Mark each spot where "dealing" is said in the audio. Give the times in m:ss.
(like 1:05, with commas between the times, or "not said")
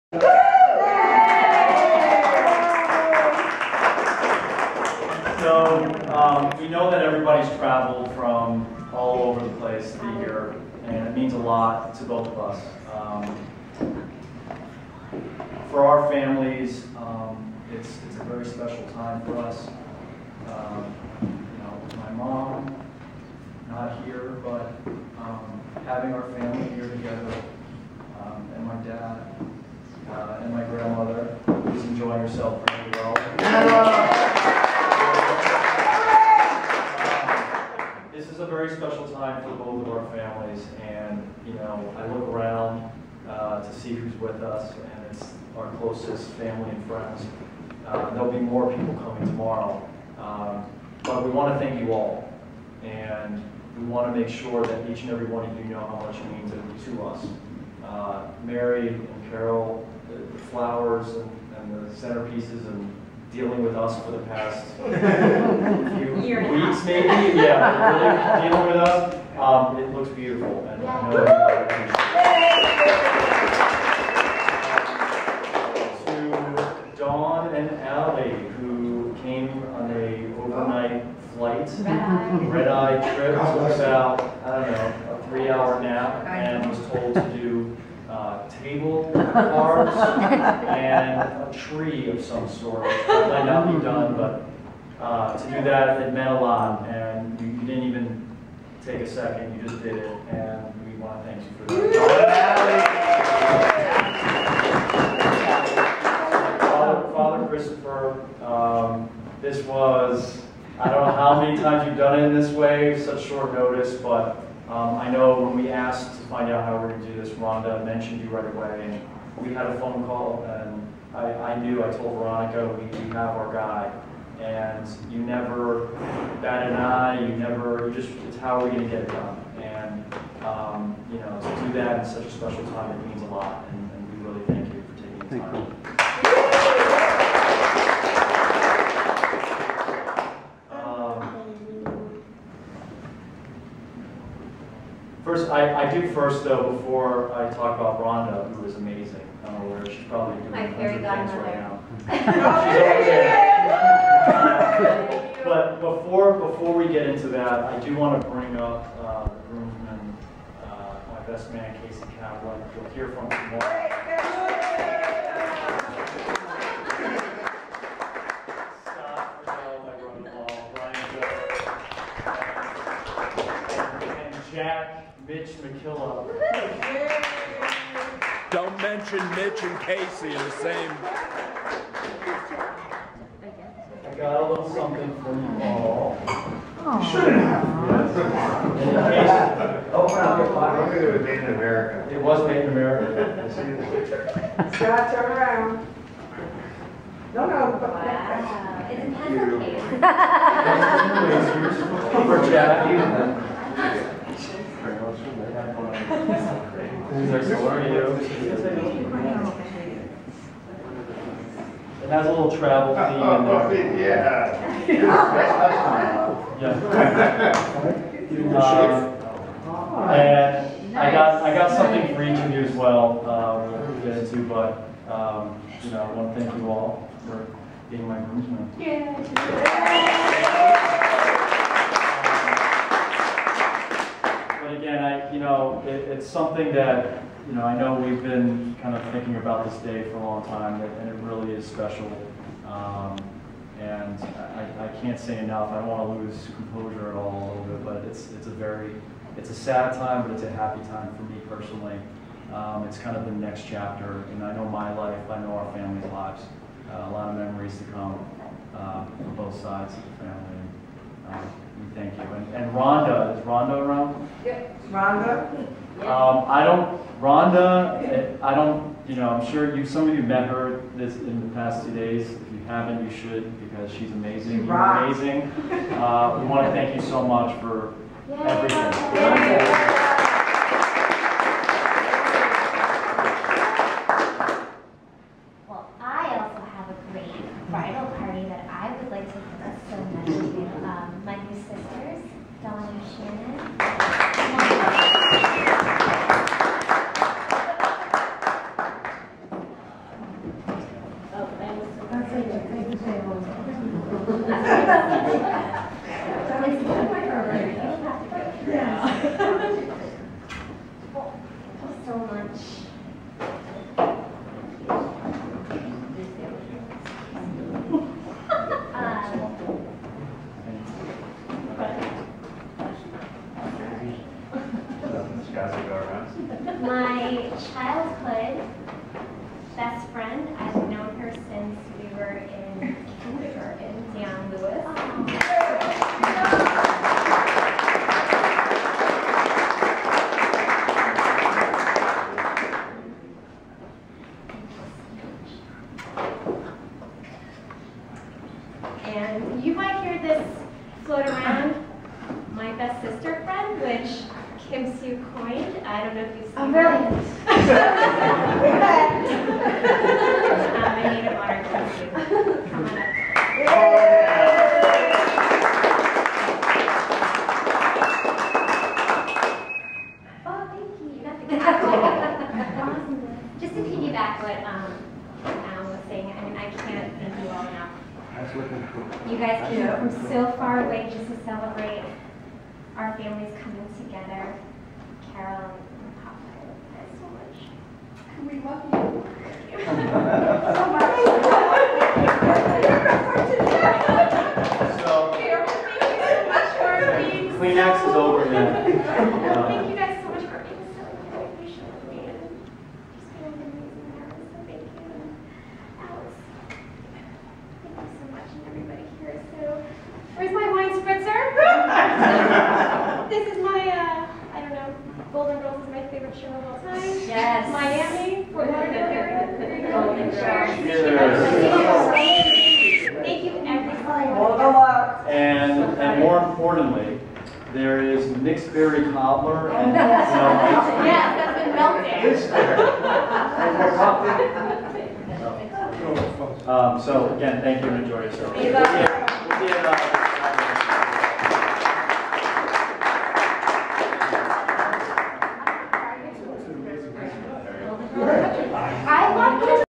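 1:03, 1:08.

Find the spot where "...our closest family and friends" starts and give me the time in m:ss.
0:45.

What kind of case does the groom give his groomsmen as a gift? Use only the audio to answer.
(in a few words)
puzzle case.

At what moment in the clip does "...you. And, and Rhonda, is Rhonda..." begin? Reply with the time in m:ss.
4:22.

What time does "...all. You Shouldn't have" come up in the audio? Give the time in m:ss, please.
3:05.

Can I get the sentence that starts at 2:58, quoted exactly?
Don't mention Mitch and Casey in the same.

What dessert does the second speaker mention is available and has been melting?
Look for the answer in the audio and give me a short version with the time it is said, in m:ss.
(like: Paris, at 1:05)
mixed berry cobbler, at 7:08.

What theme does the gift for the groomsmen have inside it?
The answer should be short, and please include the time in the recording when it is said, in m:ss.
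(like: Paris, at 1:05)
travel, at 3:32.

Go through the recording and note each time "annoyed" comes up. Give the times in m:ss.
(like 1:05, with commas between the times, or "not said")
not said.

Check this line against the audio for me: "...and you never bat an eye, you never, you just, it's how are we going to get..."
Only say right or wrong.
right.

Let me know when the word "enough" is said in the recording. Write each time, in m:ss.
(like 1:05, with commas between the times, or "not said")
4:05, 6:17.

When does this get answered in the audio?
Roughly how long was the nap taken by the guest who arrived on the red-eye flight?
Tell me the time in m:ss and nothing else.
1:25.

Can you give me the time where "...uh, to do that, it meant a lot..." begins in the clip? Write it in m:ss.
1:35.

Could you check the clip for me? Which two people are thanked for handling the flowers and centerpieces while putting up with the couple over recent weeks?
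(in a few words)
Mary and Carol.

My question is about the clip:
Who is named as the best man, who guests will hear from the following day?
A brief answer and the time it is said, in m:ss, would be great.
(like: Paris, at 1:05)
Casey Kaplan, at 2:41.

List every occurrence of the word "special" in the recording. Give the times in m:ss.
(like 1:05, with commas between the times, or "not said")
0:18, 2:12, 4:01.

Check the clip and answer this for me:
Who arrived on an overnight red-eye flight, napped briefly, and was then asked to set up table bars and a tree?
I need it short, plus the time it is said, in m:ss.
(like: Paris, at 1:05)
Alley, at 1:17.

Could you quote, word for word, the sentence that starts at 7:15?
so, um, so again, thank you and enjoy yourself.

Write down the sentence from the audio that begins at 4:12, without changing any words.
Um, it's kind of the next chapter, and I know my life, I know our family's lives.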